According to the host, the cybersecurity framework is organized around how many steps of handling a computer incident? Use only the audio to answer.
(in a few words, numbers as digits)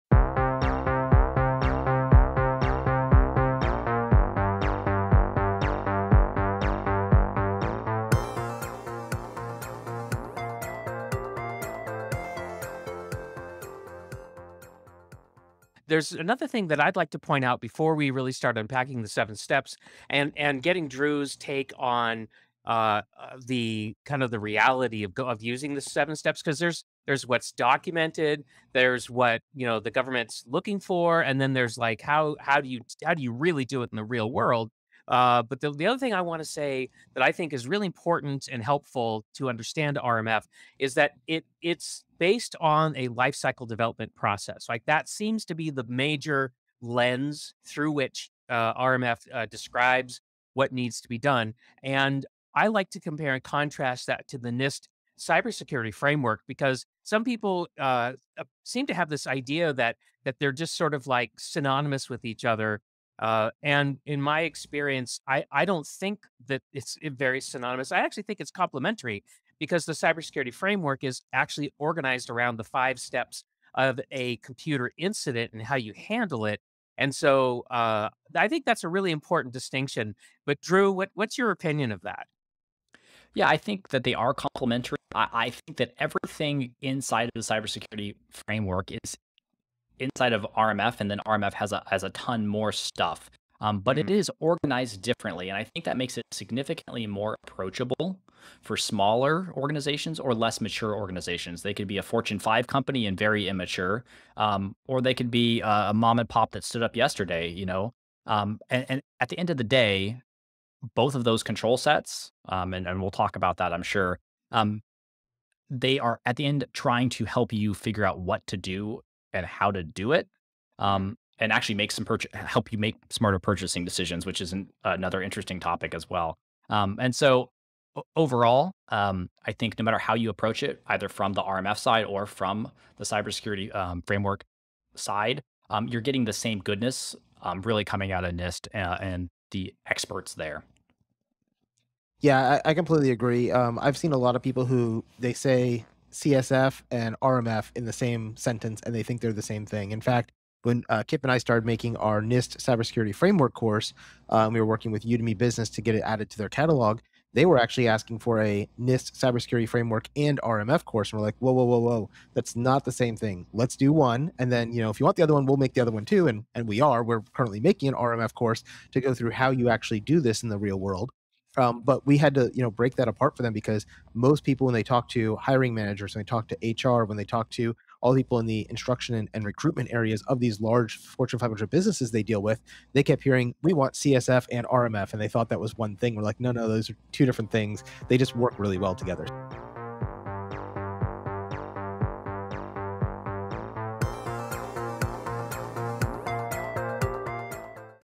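5.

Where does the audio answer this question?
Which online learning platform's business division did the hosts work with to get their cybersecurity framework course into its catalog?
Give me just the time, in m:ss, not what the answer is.
2:35.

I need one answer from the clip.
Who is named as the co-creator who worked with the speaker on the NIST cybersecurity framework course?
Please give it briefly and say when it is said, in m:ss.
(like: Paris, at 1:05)
Kip, at 2:31.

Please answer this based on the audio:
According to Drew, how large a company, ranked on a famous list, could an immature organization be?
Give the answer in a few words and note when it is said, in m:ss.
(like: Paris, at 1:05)
Fortune 5 company, at 1:42.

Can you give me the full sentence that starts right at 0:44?
Like that seems to be the major lens through which uh, RMF uh, describes what needs to be done.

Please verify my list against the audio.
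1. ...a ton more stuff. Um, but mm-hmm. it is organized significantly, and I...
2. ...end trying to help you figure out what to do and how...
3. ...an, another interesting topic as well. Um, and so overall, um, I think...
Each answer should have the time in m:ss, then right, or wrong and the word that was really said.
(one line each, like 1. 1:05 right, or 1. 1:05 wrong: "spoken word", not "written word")
1. 1:32 wrong: "differently", not "significantly"
2. 1:56 right
3. 2:04 right.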